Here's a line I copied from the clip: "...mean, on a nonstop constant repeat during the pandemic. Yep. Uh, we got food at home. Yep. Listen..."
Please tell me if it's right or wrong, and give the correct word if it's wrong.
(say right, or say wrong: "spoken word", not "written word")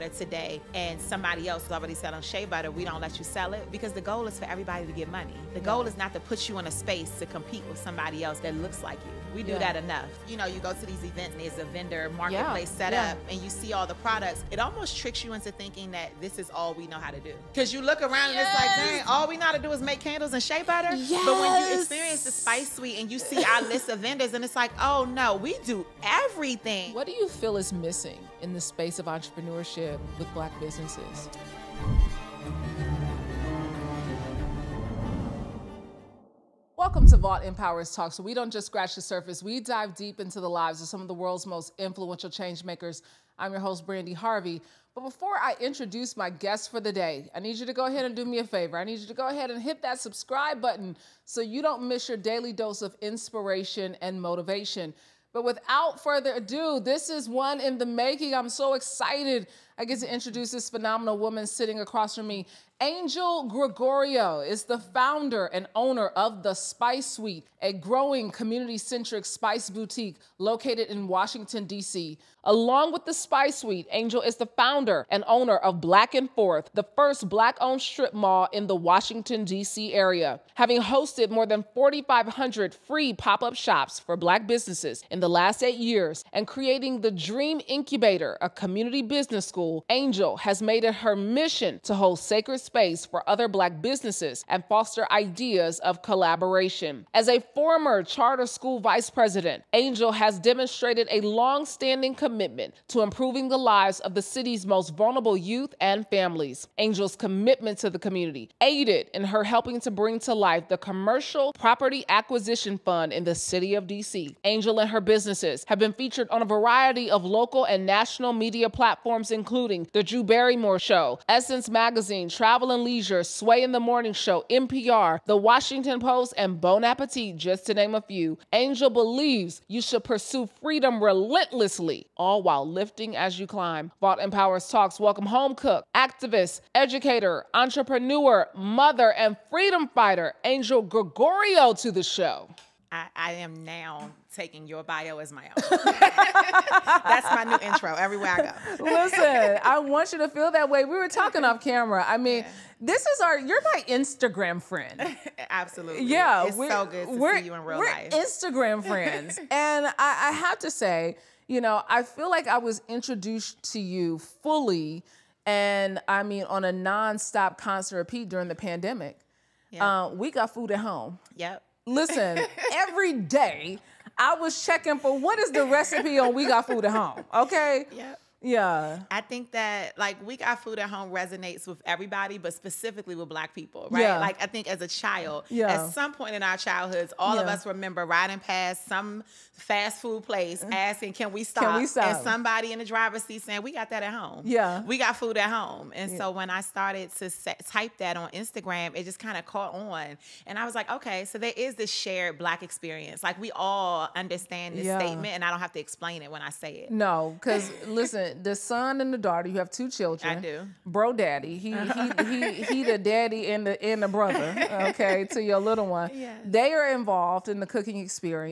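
right.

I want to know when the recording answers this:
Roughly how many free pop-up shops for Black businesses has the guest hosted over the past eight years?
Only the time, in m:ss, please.
1:21.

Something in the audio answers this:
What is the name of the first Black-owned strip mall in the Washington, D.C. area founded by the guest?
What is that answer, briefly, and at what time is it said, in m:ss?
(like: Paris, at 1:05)
Black and Forth, at 1:15.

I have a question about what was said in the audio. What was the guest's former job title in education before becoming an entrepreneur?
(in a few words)
Charter school vice president.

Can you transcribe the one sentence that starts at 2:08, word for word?
Angel believes you should pursue freedom relentlessly all while lifting as you climb.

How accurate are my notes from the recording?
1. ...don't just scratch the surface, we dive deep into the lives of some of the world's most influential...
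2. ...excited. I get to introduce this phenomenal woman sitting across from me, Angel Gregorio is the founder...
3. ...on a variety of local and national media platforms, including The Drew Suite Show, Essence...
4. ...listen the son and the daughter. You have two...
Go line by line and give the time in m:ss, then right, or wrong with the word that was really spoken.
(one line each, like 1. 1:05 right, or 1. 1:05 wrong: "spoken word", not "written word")
1. 0:38 right
2. 0:58 right
3. 1:56 wrong: "Barrymore", not "Suite"
4. 3:27 right.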